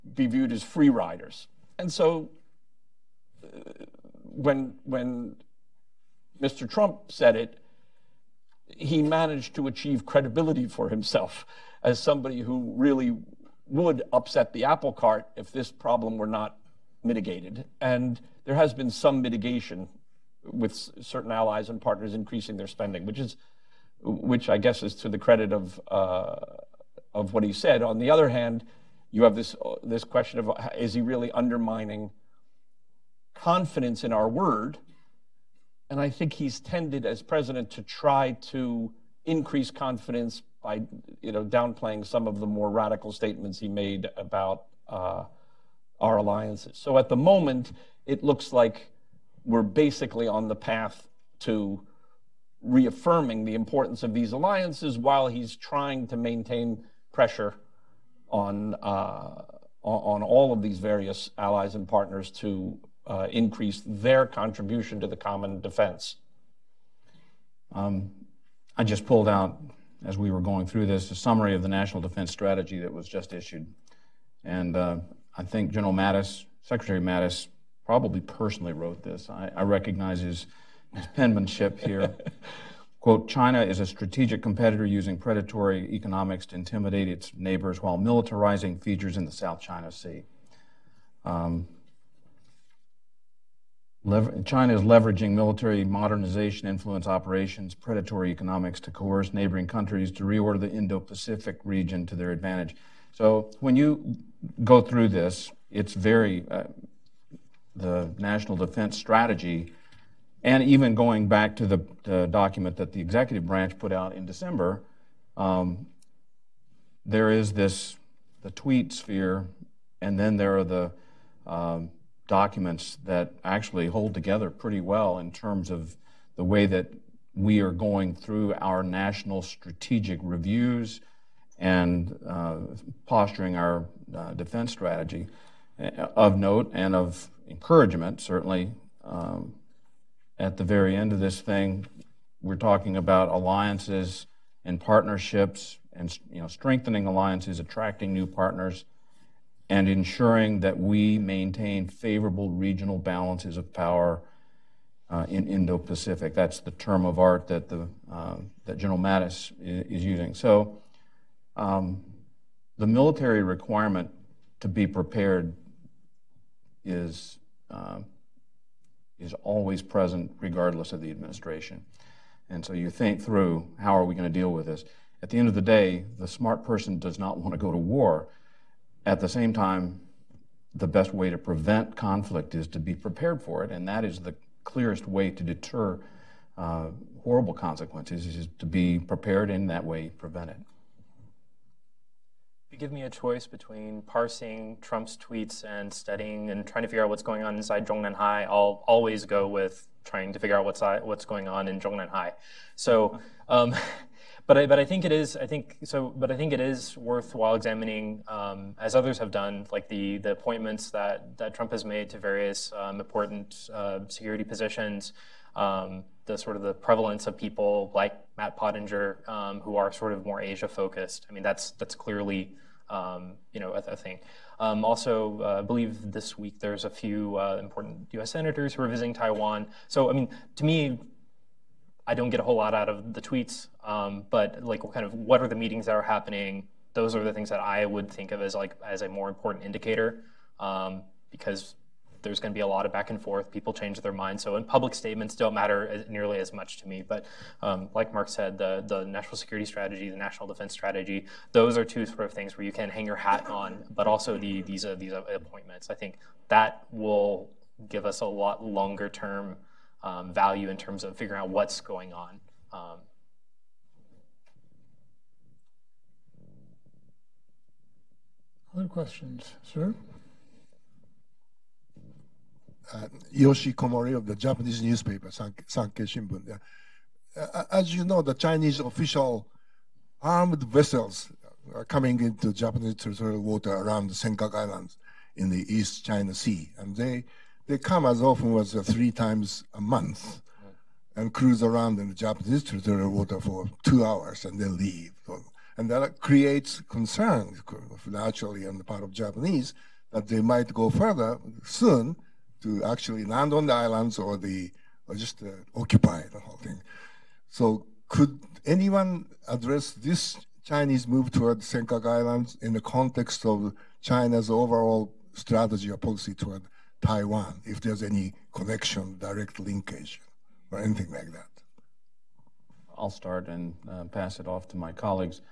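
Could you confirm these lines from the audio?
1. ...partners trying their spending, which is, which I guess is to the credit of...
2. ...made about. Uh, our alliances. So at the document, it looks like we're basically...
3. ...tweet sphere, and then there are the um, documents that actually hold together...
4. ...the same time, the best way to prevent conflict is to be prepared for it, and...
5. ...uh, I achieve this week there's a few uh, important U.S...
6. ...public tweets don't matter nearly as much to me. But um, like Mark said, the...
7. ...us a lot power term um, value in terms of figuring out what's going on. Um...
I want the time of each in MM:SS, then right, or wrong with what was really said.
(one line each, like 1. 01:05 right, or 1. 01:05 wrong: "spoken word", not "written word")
1. 00:21 wrong: "increasing", not "trying"
2. 00:43 wrong: "moment", not "document"
3. 01:58 right
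4. 02:59 right
5. 03:45 wrong: "believe", not "achieve"
6. 04:04 wrong: "statements", not "tweets"
7. 04:18 wrong: "longer", not "power".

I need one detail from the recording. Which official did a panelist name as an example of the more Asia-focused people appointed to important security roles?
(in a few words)
Matt Pottinger.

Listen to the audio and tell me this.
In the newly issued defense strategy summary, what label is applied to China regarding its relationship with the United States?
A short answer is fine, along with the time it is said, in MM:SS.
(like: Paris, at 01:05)
strategic competitor, at 01:23.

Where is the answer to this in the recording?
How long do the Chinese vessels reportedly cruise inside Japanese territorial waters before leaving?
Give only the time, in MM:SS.
04:53.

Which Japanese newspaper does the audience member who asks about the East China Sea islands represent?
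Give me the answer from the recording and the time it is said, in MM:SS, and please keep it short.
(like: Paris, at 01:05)
Sankei Shimbun, at 04:35.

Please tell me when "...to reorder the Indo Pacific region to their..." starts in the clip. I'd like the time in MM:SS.
01:40.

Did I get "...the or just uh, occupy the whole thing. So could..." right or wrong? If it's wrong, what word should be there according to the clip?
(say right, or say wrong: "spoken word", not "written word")
right.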